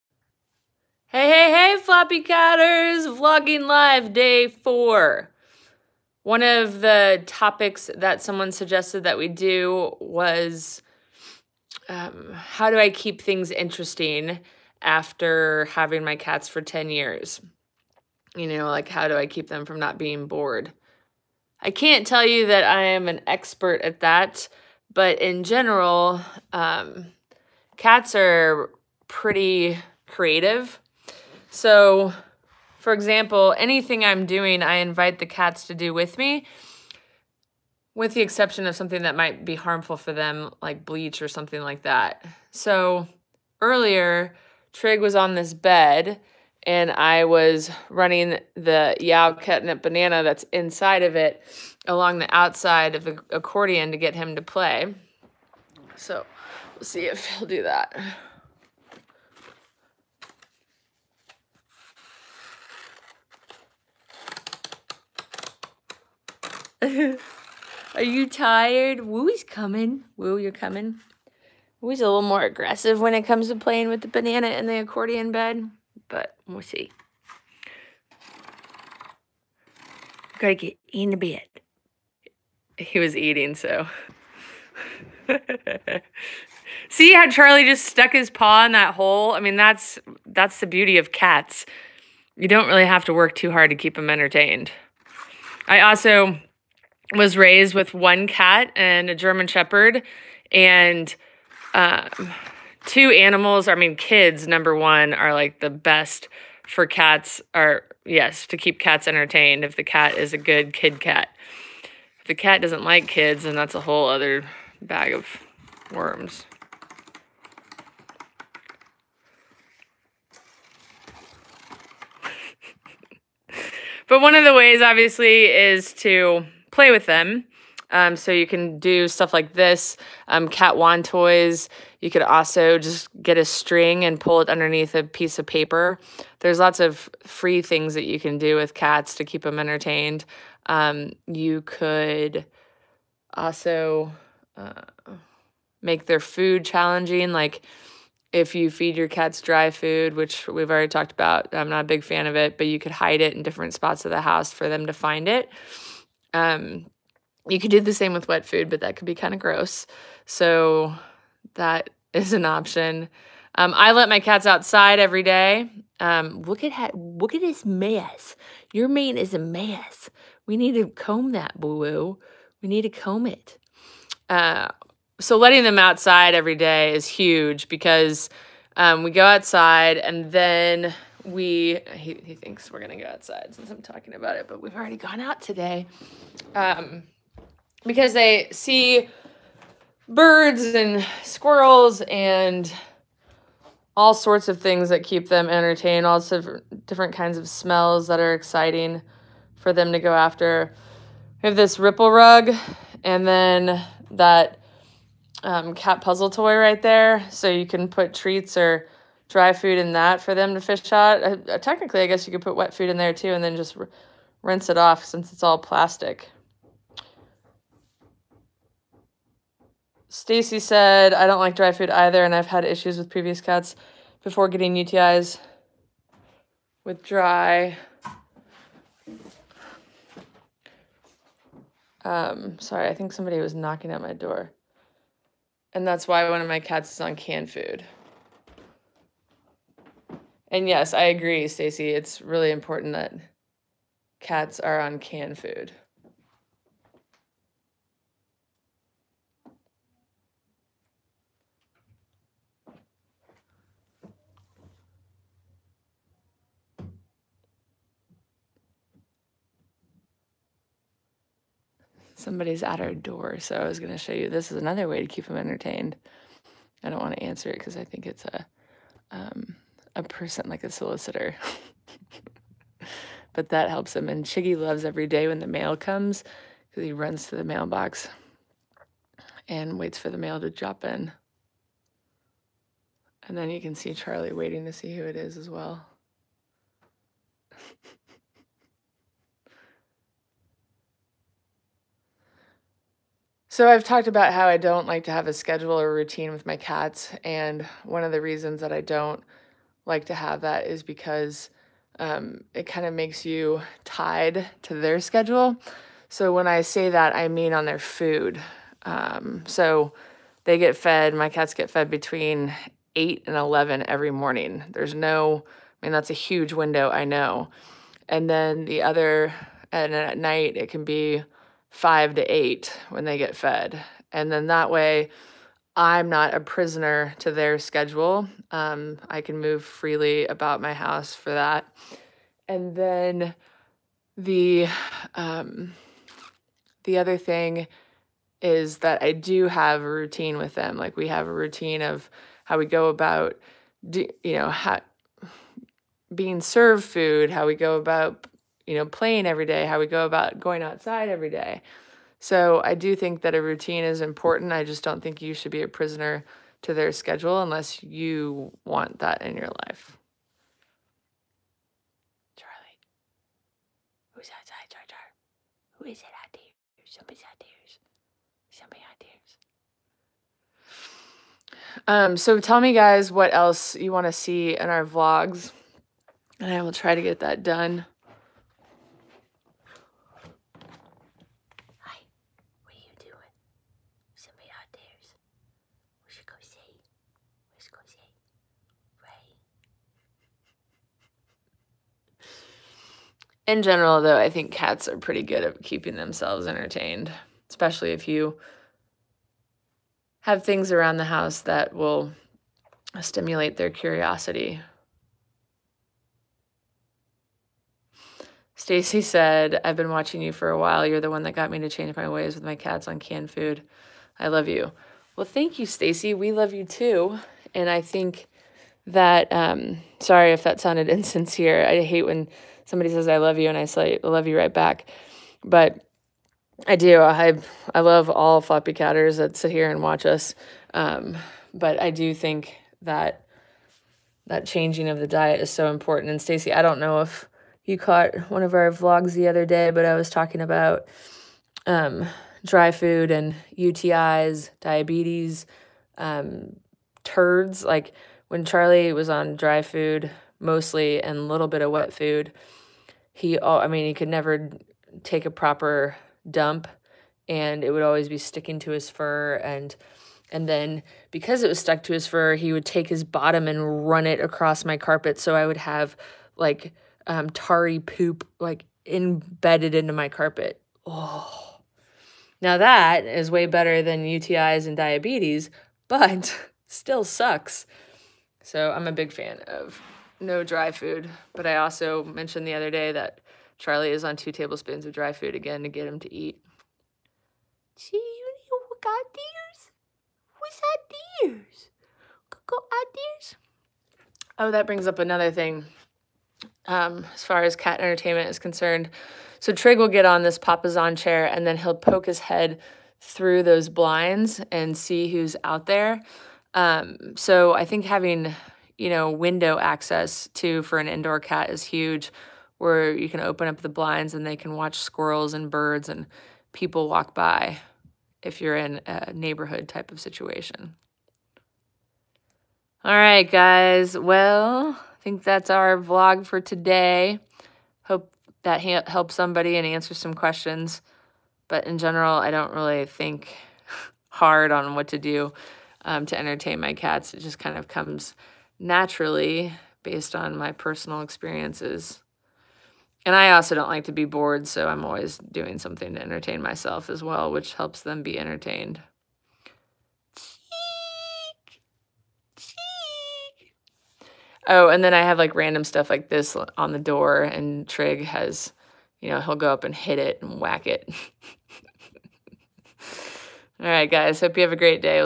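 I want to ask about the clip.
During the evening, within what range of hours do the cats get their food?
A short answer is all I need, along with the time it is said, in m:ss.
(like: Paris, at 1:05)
5 to 8, at 5:21.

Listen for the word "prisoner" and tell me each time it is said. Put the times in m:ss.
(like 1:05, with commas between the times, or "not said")
5:26, 5:55.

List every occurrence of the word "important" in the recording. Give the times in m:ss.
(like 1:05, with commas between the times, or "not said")
4:02, 5:53, 7:15.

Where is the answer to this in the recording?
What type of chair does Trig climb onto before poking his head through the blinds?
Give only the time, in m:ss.
8:20.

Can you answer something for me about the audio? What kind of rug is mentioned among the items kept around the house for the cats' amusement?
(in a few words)
ripple rug.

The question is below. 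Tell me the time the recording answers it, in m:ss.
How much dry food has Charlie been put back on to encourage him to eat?
8:04.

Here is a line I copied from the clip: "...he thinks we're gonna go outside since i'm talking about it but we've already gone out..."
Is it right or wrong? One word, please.
right.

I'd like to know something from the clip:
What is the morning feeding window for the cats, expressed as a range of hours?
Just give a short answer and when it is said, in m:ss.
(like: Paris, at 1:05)
8 to 11, at 5:11.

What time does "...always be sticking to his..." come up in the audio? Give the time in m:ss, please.
7:37.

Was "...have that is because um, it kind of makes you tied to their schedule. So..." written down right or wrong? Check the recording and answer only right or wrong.
right.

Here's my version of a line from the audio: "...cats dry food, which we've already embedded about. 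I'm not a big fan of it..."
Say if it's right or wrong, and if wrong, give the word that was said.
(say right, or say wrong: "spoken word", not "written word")
wrong: "talked", not "embedded".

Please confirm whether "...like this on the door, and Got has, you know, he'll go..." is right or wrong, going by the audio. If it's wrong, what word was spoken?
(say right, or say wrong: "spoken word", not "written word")
wrong: "Trig", not "Got".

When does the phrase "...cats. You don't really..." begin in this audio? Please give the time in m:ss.
1:31.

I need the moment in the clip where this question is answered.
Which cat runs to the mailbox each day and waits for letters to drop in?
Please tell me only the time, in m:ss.
4:34.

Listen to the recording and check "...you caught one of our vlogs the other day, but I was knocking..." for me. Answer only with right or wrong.
wrong.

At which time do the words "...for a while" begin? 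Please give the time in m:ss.
6:50.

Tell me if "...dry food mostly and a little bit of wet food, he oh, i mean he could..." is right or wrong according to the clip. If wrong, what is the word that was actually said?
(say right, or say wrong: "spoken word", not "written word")
right.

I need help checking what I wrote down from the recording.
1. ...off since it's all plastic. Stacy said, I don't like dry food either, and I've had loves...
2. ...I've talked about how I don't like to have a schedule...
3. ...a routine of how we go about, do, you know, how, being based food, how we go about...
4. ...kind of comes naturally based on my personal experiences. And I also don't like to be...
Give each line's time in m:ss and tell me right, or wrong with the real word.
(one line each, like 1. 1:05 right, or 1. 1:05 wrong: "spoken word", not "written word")
1. 3:34 wrong: "issues", not "loves"
2. 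4:53 right
3. 5:41 wrong: "served", not "based"
4. 8:57 right.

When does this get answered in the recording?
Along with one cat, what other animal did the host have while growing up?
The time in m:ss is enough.
1:39.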